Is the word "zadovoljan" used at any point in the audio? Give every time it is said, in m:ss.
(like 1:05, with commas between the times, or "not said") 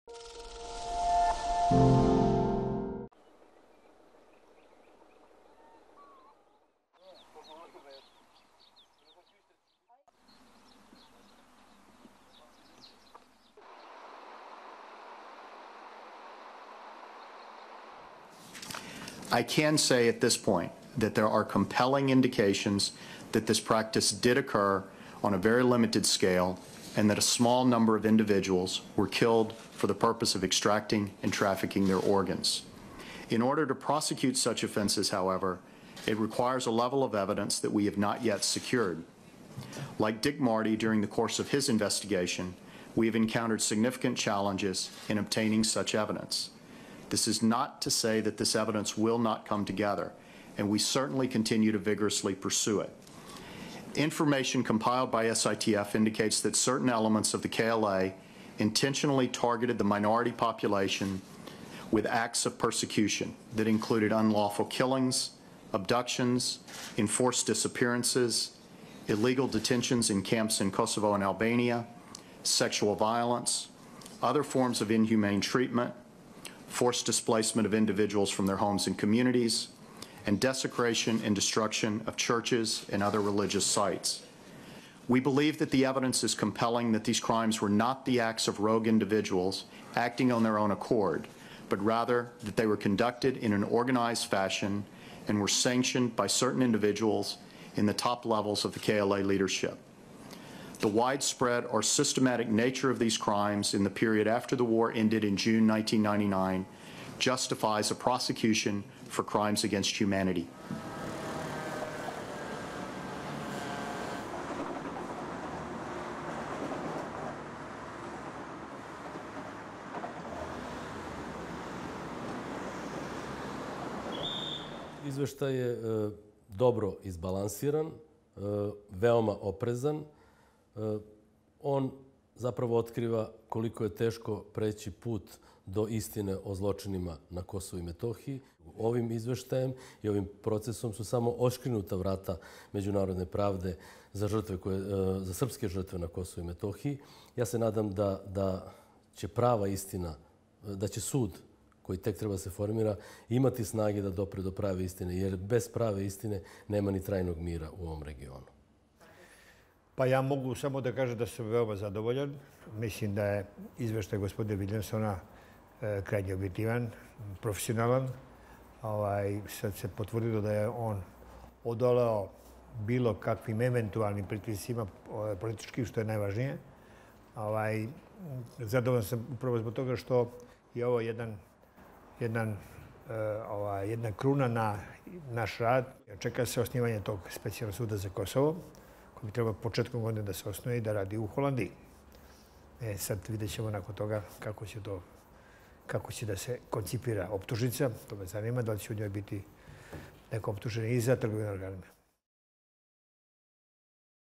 2:41, 2:58.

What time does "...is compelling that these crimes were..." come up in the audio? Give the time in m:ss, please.
1:26.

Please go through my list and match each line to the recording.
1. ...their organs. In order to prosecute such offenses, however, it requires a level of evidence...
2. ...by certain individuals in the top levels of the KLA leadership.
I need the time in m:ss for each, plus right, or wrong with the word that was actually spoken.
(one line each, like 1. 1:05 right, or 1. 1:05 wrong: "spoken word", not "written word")
1. 0:31 right
2. 1:36 right.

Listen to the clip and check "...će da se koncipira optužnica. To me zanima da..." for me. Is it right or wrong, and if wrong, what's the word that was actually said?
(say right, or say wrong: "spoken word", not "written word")
right.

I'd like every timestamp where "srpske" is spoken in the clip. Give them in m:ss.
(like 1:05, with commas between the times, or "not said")
2:25.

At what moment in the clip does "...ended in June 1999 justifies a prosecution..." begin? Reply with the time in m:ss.
1:44.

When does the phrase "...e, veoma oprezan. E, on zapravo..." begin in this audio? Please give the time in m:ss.
2:07.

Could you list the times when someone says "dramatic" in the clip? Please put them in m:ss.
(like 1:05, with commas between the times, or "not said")
not said.